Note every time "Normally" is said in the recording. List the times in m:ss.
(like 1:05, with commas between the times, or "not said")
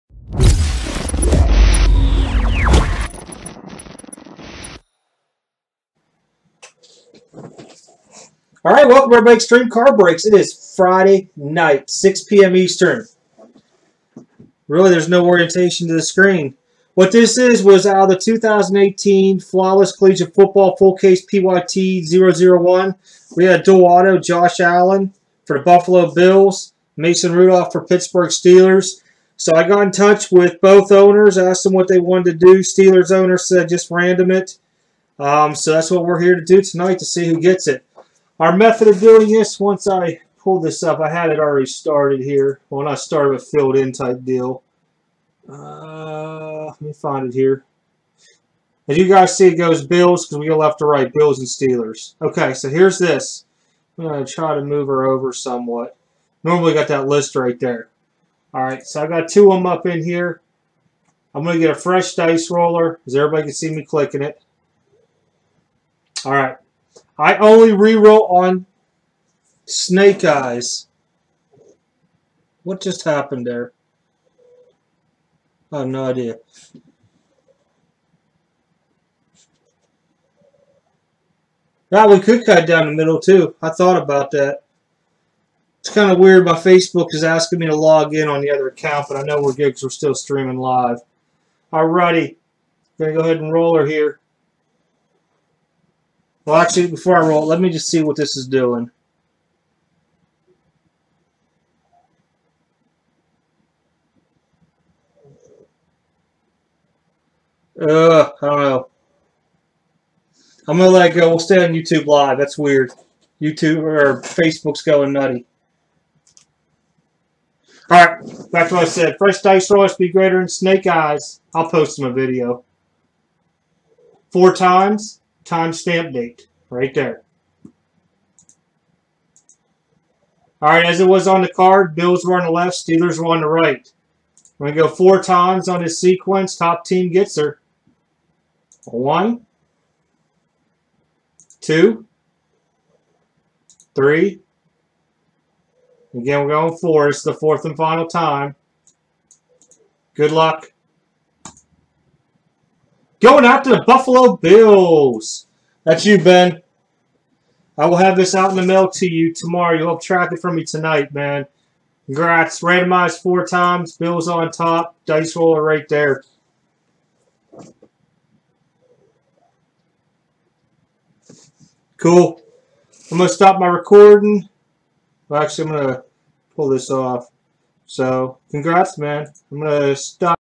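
0:56.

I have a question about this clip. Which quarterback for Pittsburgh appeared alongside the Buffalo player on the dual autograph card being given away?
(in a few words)
Mason Rudolph.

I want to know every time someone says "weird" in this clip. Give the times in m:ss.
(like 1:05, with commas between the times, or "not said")
1:26, 1:52.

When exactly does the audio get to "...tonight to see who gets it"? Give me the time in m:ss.
0:36.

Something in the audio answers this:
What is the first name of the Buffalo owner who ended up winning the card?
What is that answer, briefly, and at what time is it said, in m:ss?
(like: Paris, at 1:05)
Ben, at 2:36.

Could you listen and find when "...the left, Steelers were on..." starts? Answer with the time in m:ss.
2:12.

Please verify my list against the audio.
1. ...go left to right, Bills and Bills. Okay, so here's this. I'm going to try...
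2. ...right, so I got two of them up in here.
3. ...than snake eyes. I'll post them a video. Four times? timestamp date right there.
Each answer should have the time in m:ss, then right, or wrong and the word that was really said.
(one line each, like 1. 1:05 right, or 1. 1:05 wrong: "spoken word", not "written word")
1. 0:50 wrong: "Steelers", not "Bills"
2. 0:58 right
3. 2:00 right.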